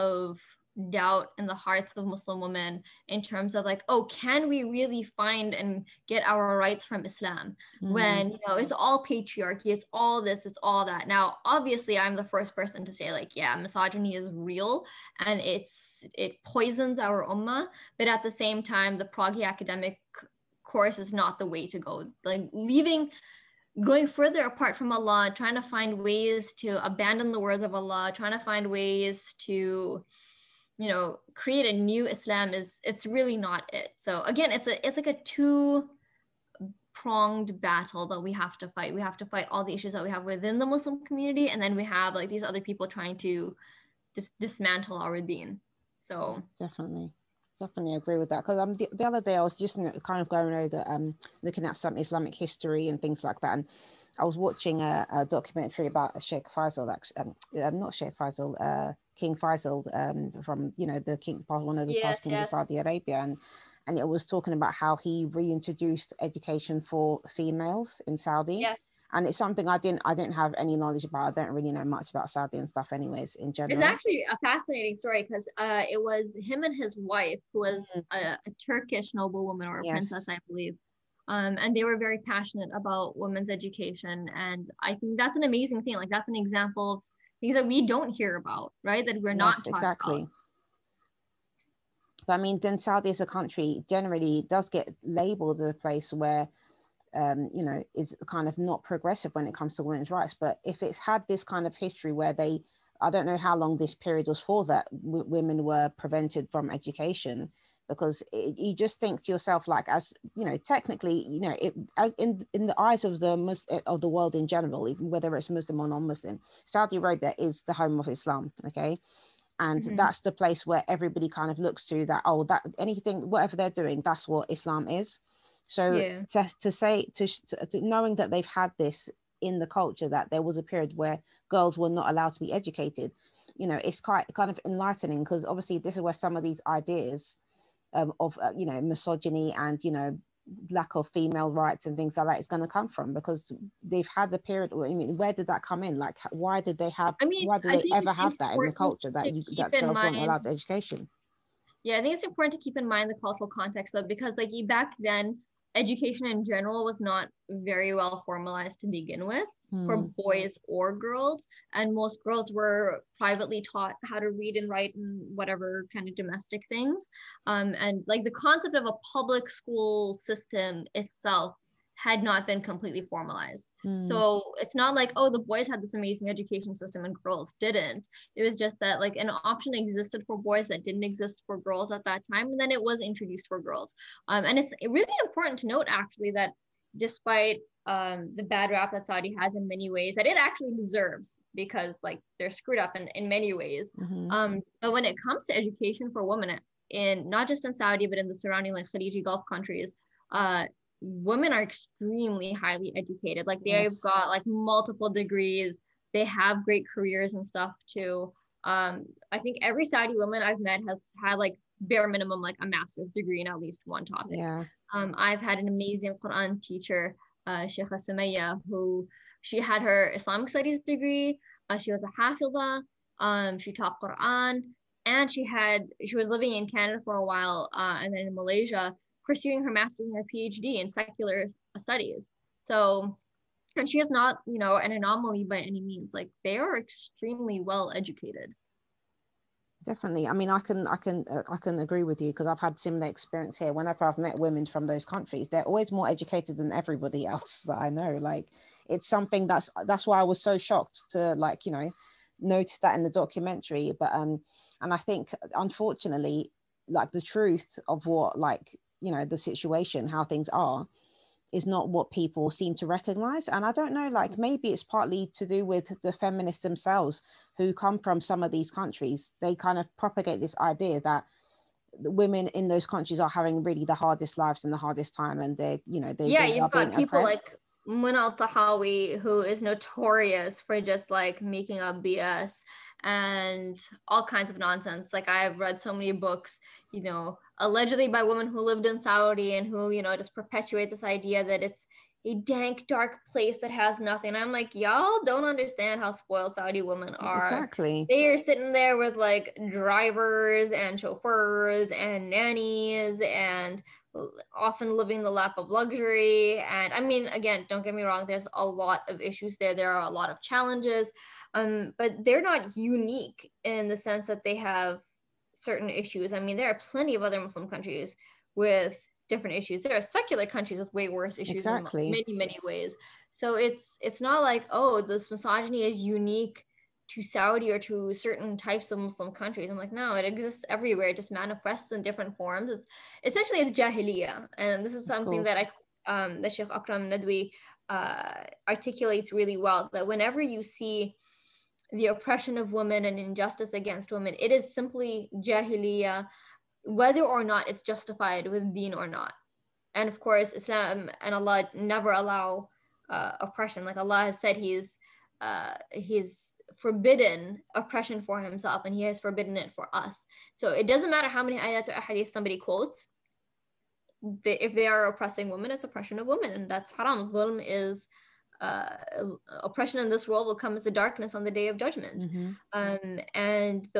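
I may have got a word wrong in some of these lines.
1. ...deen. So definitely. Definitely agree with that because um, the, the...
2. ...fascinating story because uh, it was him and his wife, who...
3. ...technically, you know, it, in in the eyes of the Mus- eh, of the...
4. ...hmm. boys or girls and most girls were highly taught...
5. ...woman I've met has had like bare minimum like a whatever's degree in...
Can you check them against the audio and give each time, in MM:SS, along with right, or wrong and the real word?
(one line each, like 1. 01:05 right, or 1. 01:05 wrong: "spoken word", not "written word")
1. 00:45 right
2. 01:14 right
3. 01:50 right
4. 02:39 wrong: "privately", not "highly"
5. 03:30 wrong: "master", not "whatever".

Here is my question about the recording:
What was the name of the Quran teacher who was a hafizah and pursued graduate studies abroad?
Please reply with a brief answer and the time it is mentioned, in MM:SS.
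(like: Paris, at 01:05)
Sheikha Sumaya, at 03:37.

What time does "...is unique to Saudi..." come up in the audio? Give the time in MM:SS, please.
05:25.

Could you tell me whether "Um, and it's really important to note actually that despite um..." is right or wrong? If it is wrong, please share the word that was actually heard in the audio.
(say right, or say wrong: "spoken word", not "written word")
right.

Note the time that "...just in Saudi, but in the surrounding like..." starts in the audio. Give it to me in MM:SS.
03:17.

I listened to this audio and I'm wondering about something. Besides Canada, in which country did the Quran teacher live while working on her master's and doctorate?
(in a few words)
Malaysia.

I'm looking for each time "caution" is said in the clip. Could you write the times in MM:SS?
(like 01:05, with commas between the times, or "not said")
not said.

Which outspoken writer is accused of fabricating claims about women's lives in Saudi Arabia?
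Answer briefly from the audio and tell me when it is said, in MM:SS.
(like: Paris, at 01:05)
Mona Eltahawy, at 04:37.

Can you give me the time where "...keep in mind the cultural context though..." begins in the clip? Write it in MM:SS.
02:32.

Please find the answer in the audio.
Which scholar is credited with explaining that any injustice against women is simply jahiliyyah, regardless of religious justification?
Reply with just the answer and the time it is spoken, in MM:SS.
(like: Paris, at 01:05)
Sheikh Akram Nadwi, at 05:36.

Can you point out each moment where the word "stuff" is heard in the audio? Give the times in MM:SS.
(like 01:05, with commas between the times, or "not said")
01:12, 03:27.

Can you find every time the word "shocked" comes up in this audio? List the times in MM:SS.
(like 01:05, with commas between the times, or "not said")
04:10.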